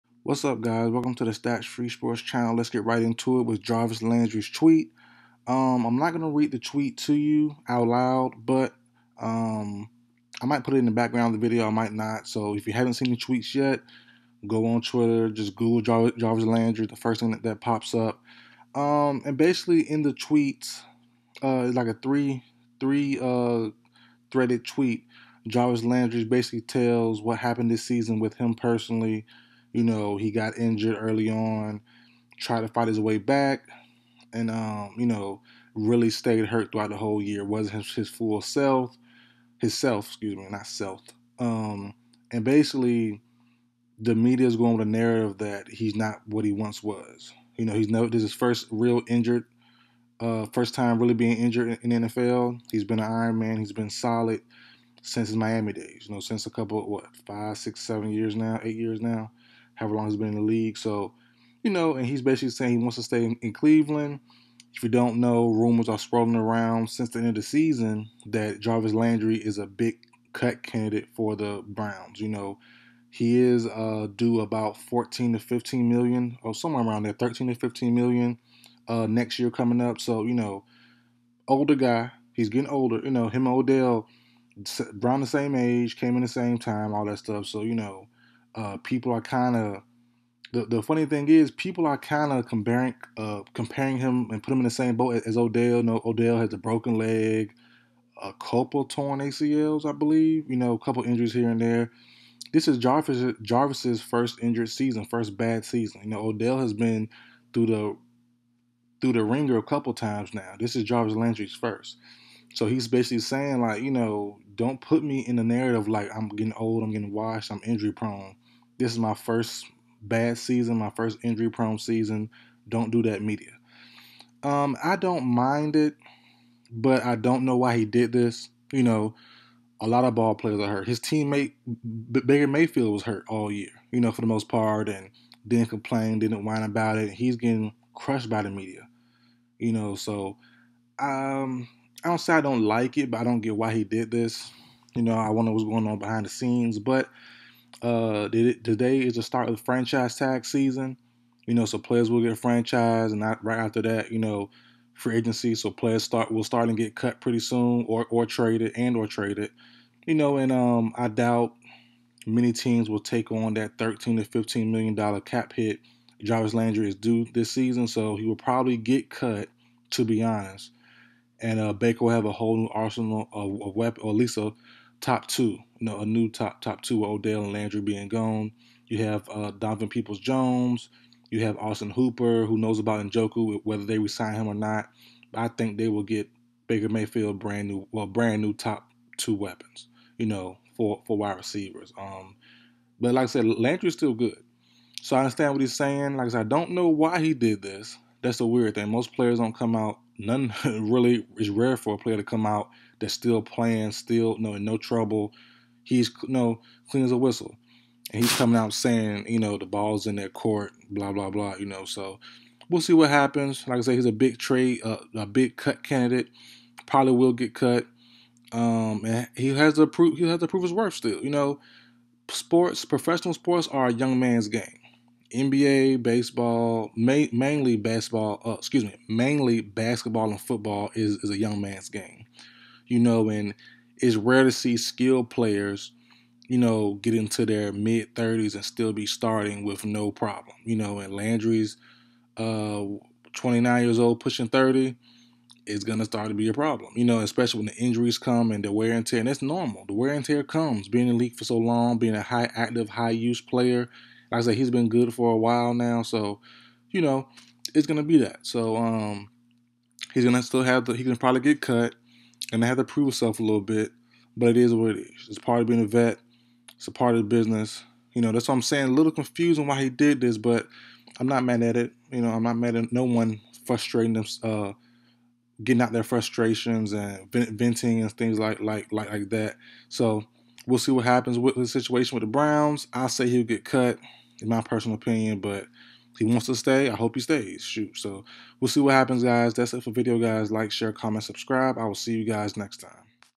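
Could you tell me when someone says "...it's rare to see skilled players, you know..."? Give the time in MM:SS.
03:53.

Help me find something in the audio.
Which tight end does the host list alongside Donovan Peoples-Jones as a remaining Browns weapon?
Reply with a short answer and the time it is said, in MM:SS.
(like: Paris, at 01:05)
Austin Hooper, at 03:01.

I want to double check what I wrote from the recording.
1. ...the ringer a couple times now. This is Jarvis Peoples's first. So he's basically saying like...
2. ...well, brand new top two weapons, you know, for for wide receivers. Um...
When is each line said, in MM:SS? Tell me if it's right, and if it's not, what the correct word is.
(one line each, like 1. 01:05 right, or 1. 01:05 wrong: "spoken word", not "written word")
1. 01:49 wrong: "Landry", not "Peoples"
2. 03:07 right.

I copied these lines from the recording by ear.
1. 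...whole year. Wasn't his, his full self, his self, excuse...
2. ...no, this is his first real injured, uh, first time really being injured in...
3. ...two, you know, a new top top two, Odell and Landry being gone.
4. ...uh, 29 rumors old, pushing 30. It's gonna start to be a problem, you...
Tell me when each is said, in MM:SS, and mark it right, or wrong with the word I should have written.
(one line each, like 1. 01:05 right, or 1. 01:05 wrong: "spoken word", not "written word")
1. 00:36 right
2. 00:47 right
3. 02:55 right
4. 04:02 wrong: "years", not "rumors".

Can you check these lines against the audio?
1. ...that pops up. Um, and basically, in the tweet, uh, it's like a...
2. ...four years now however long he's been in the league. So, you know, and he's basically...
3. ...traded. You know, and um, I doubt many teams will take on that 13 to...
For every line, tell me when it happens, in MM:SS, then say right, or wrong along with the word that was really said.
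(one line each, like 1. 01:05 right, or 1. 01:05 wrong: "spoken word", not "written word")
1. 00:17 right
2. 00:58 wrong: "eight", not "four"
3. 02:39 right.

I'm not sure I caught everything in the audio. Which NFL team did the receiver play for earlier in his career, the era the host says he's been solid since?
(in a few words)
Miami.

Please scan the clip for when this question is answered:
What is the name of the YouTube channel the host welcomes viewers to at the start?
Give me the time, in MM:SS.
00:01.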